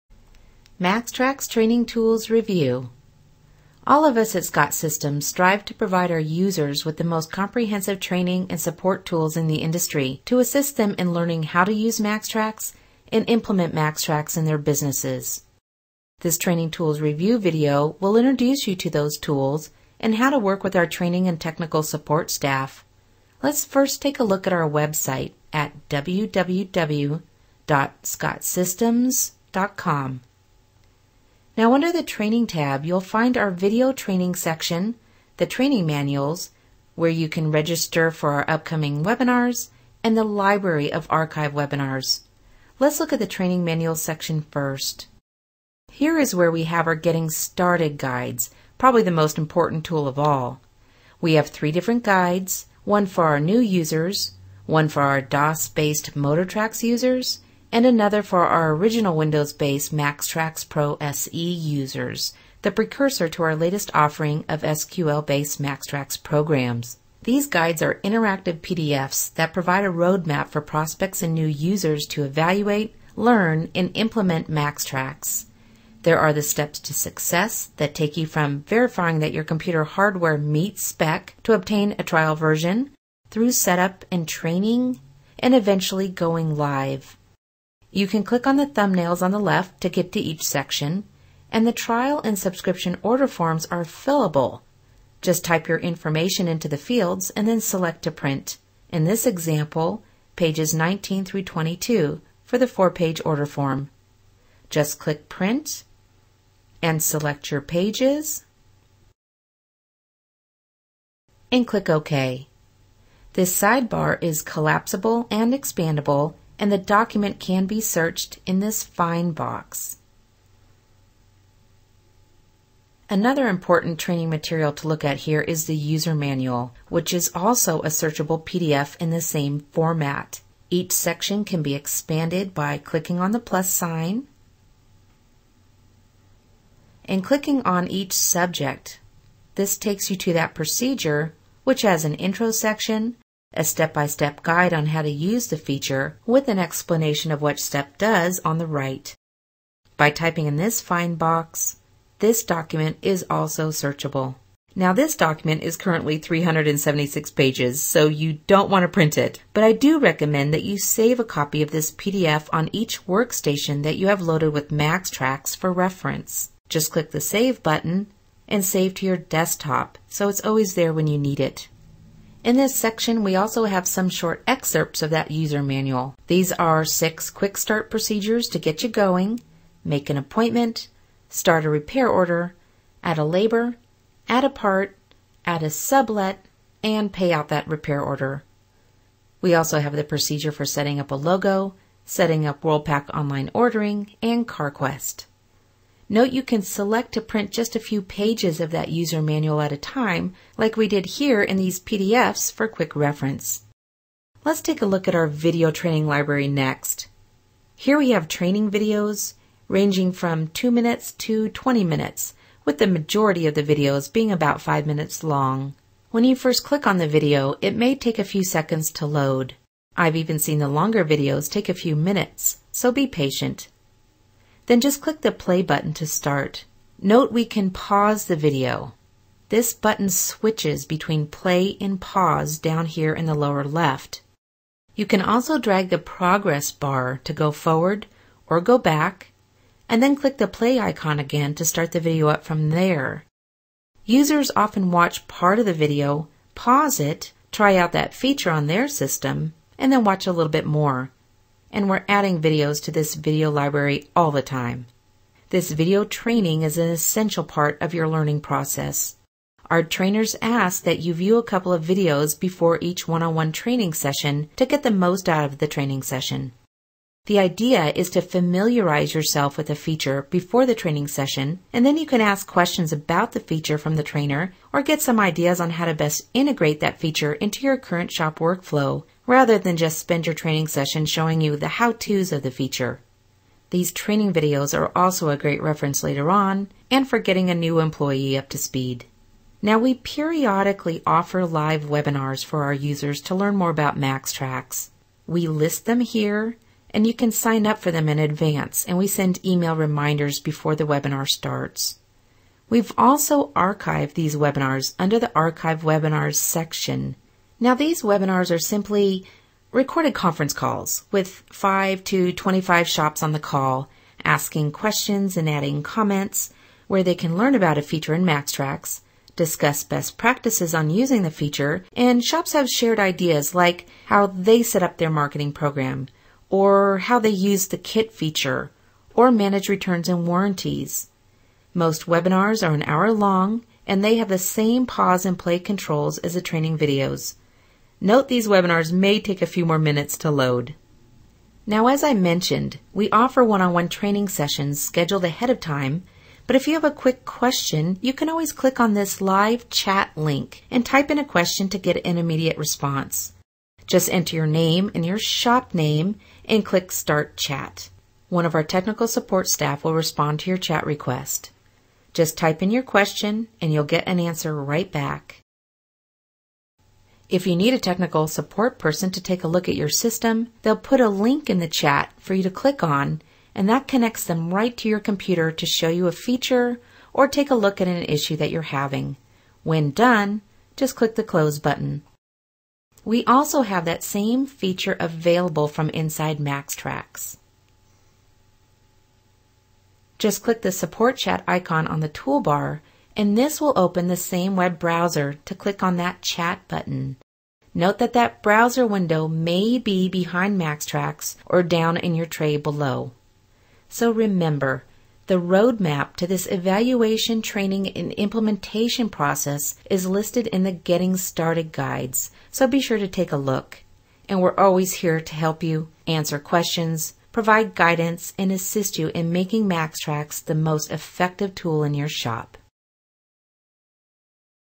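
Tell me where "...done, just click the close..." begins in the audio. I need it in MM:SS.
06:19.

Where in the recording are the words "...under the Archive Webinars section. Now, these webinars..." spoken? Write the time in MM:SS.
05:04.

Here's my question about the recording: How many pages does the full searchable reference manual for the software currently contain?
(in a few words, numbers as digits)
376.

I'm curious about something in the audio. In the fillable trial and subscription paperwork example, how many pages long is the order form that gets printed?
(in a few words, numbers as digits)
4.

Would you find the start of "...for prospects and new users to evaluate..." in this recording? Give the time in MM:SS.
01:10.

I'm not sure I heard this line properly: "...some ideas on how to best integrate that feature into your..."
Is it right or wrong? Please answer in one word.
right.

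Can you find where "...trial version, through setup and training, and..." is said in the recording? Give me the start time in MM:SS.
01:22.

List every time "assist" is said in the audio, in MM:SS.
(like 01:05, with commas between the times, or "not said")
00:10, 06:58.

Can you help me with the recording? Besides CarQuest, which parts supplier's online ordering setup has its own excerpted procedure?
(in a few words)
WorldPac.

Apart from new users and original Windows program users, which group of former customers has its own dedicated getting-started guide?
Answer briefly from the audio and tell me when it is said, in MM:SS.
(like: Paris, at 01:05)
DOS-based MotorTrax users, at 00:55.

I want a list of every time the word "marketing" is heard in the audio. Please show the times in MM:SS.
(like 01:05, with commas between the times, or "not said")
05:25.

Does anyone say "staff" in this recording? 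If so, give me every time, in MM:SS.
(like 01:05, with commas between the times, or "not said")
00:22, 05:59.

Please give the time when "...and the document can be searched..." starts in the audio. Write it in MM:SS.
01:56.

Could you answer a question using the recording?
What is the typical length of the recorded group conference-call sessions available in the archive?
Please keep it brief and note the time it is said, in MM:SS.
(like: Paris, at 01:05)
1 hour, at 05:32.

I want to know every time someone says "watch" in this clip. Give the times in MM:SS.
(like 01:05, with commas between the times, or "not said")
04:04, 04:10.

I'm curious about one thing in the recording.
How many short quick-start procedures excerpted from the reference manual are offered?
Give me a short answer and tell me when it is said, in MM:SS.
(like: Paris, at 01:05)
6, at 02:56.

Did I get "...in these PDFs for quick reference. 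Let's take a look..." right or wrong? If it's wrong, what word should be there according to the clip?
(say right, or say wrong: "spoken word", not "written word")
right.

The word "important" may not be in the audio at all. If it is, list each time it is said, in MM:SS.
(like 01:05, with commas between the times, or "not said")
00:49, 02:03.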